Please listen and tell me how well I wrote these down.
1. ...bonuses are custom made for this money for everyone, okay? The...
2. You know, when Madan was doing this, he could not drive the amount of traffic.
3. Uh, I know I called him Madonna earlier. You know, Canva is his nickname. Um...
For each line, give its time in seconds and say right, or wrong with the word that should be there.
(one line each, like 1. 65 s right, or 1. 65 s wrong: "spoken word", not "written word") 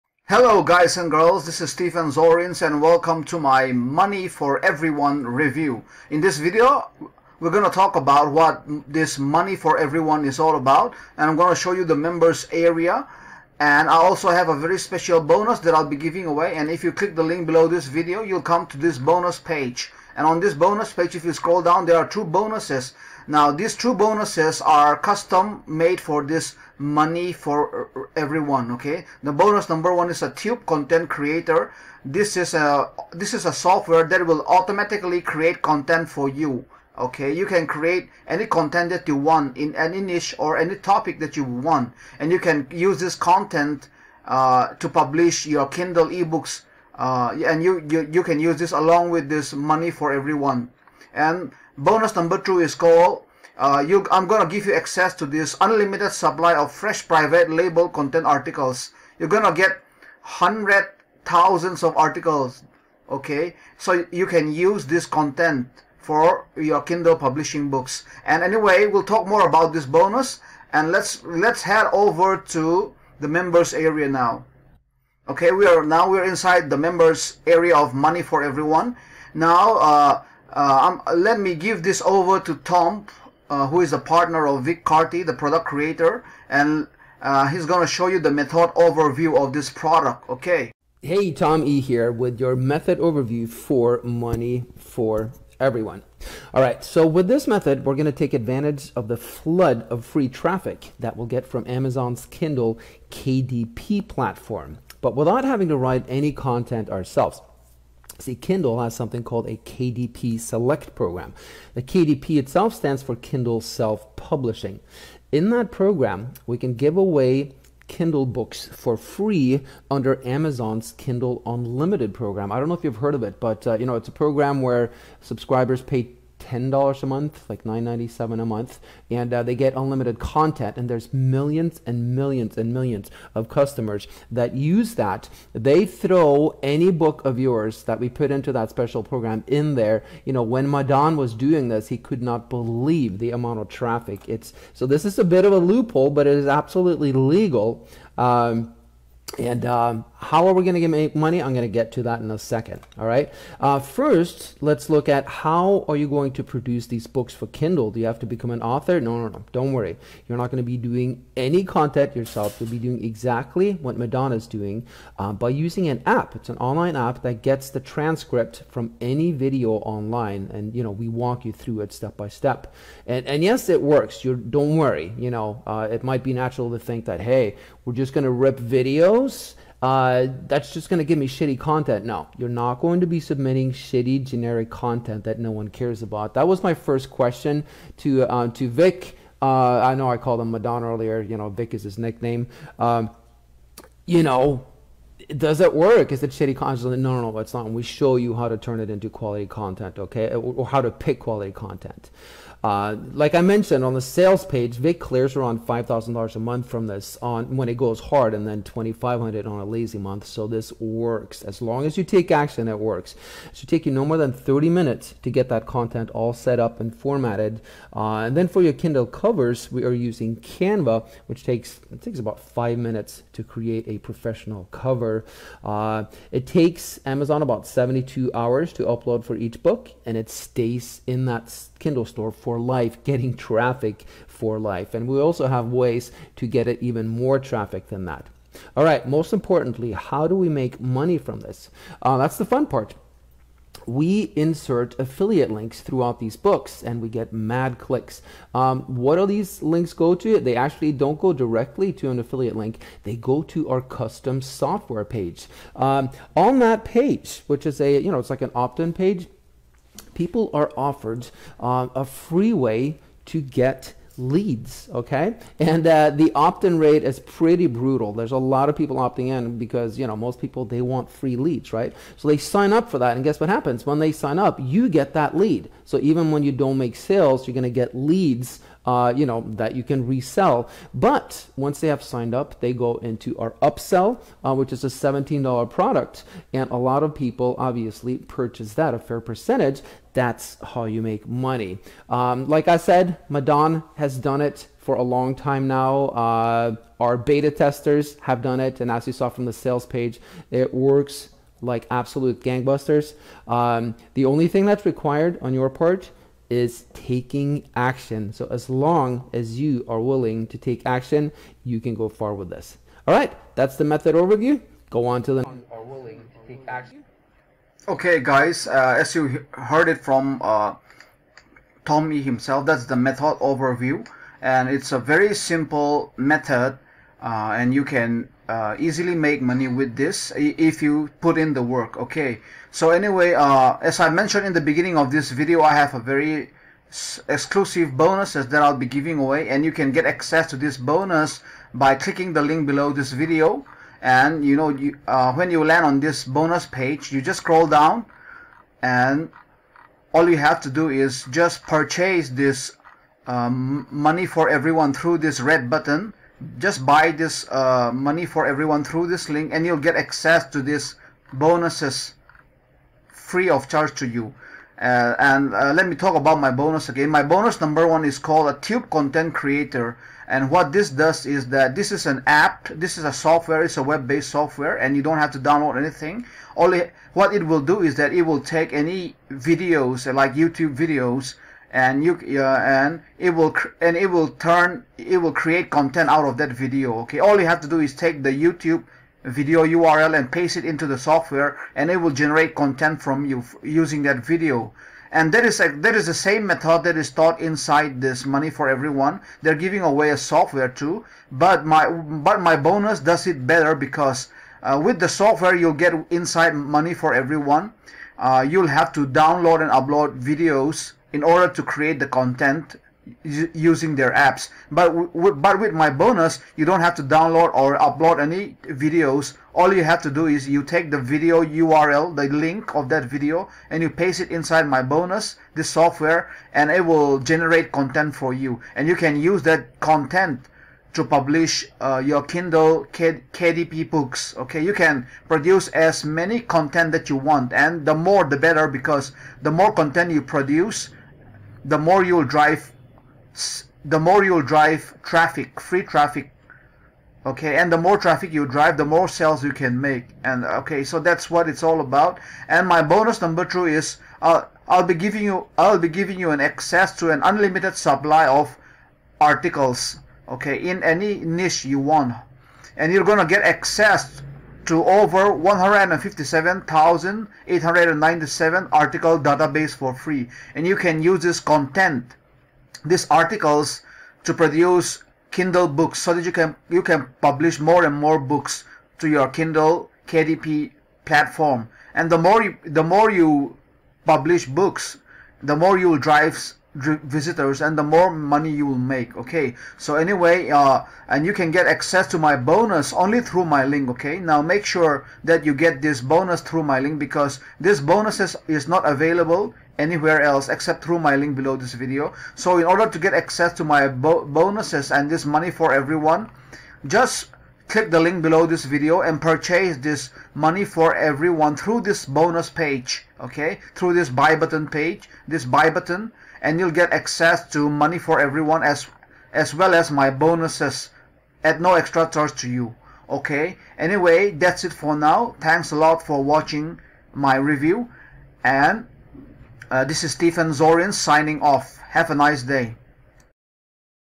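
1. 23 s right
2. 140 s wrong: "believe", not "drive"
3. 189 s wrong: "Vick", not "Canva".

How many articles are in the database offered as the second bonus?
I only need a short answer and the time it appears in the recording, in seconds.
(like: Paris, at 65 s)
157,897, at 465 s.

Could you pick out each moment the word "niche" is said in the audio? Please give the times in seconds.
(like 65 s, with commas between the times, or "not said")
40 s, 461 s.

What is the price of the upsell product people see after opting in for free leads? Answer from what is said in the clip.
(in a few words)
$17.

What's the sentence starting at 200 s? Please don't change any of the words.
Or how to pick quality content.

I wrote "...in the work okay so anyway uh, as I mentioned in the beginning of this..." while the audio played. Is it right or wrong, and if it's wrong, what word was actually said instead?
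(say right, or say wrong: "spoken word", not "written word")
right.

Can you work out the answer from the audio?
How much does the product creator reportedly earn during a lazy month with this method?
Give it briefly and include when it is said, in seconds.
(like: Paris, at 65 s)
$2,500, at 208 s.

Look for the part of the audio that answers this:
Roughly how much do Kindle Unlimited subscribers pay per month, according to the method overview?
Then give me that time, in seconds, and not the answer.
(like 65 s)
127 s.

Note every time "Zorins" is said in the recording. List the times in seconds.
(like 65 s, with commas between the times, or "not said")
2 s, 530 s.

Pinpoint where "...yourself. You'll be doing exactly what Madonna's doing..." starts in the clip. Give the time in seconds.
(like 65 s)
162 s.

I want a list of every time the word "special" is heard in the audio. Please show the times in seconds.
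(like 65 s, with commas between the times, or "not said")
14 s, 138 s.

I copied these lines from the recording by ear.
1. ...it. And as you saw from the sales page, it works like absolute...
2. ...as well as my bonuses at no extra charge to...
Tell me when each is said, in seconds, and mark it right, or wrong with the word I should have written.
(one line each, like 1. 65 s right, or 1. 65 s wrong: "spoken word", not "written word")
1. 298 s right
2. 519 s right.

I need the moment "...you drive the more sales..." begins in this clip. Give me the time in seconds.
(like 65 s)
448 s.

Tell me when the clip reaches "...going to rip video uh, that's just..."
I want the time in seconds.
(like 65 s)
178 s.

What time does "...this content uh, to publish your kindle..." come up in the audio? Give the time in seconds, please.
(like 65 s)
42 s.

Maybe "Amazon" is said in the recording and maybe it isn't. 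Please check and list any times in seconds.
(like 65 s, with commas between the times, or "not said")
101 s, 120 s, 227 s.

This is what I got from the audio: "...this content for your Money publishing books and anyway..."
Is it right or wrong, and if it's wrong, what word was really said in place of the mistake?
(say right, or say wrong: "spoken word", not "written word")
wrong: "Kindle", not "Money".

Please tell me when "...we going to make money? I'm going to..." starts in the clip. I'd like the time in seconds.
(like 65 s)
150 s.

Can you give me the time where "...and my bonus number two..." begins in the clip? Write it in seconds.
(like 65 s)
452 s.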